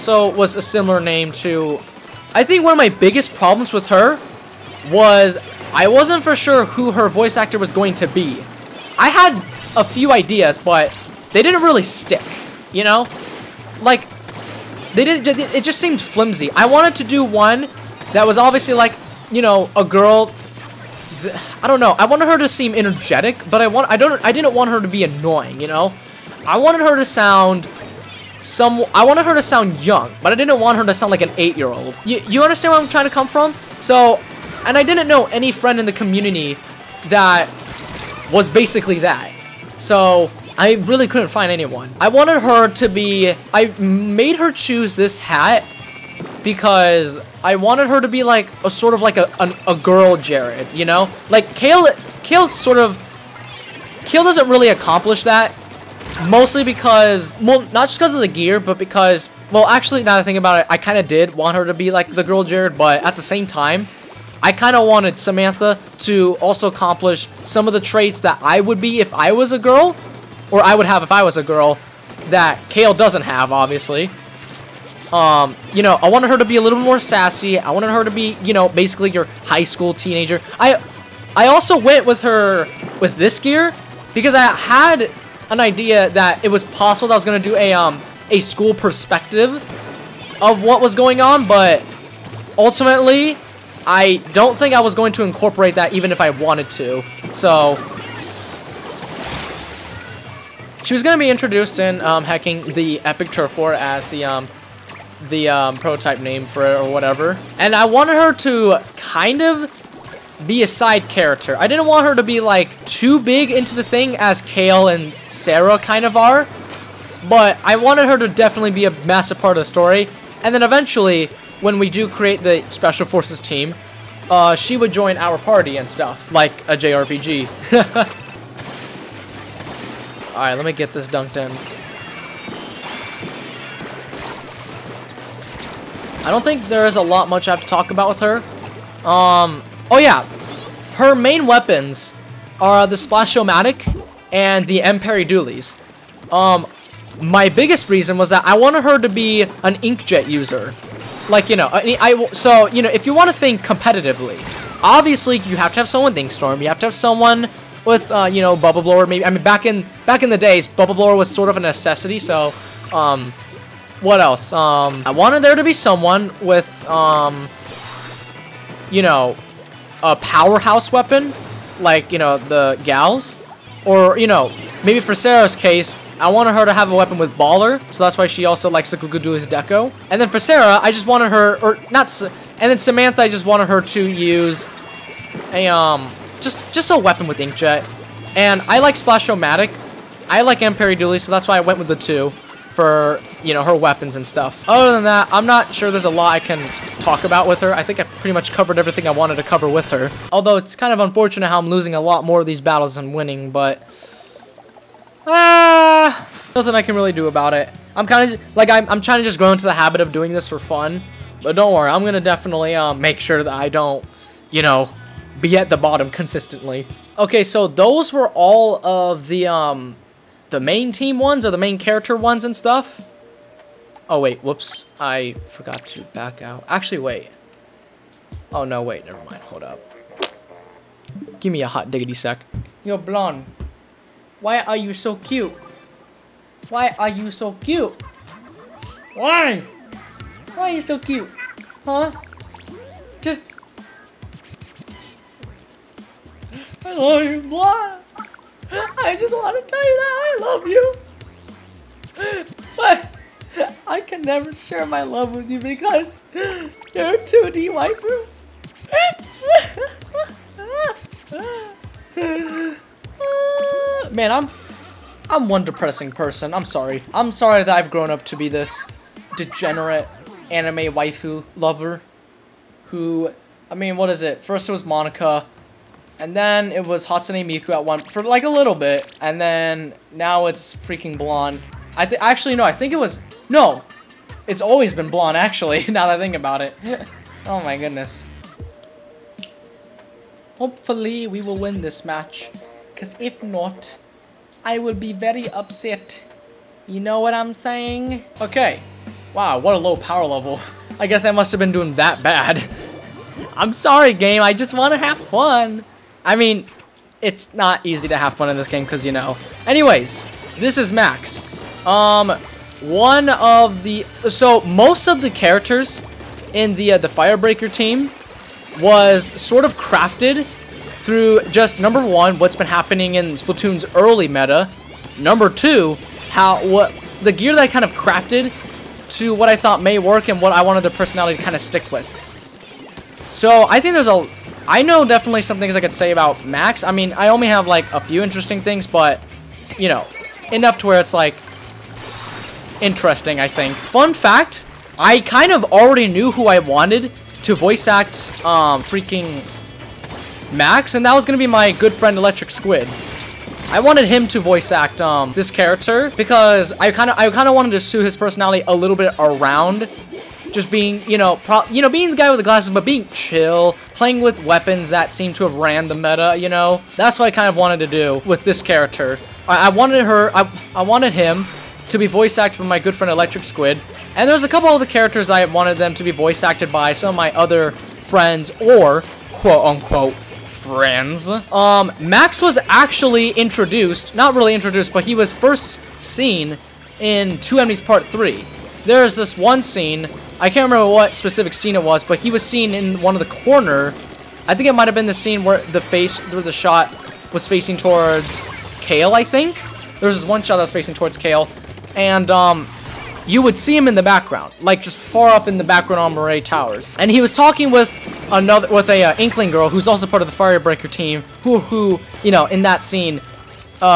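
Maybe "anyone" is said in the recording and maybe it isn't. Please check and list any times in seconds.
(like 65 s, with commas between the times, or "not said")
41 s.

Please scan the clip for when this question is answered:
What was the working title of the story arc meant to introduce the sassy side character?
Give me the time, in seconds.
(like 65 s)
102 s.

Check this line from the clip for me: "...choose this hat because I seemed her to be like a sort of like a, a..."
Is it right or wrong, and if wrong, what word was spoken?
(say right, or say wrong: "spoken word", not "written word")
wrong: "wanted", not "seemed".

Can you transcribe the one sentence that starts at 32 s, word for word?
You, you understand where I'm trying to come from?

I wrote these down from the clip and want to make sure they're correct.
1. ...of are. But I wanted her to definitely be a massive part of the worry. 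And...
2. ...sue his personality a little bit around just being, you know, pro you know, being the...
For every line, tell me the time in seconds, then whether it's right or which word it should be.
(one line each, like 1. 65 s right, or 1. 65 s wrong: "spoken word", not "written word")
1. 116 s wrong: "story", not "worry"
2. 357 s right.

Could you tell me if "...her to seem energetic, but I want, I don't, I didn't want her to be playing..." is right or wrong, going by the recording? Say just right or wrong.
wrong.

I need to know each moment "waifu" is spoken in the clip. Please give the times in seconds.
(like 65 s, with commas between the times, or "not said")
257 s, 270 s.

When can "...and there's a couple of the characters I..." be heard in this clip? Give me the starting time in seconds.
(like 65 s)
374 s.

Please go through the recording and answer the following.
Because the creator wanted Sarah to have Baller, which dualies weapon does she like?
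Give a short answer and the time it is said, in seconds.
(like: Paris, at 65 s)
Glooga Dualies Deco, at 178 s.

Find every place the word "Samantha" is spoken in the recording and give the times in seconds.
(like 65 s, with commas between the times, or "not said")
65 s, 182 s.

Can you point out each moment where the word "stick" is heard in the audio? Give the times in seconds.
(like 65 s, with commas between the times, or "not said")
11 s, 331 s.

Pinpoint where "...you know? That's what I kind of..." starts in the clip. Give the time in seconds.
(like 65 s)
366 s.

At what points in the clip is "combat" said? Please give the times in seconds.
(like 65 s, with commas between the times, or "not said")
not said.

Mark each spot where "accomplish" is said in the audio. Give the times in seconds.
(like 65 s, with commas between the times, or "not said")
54 s, 66 s.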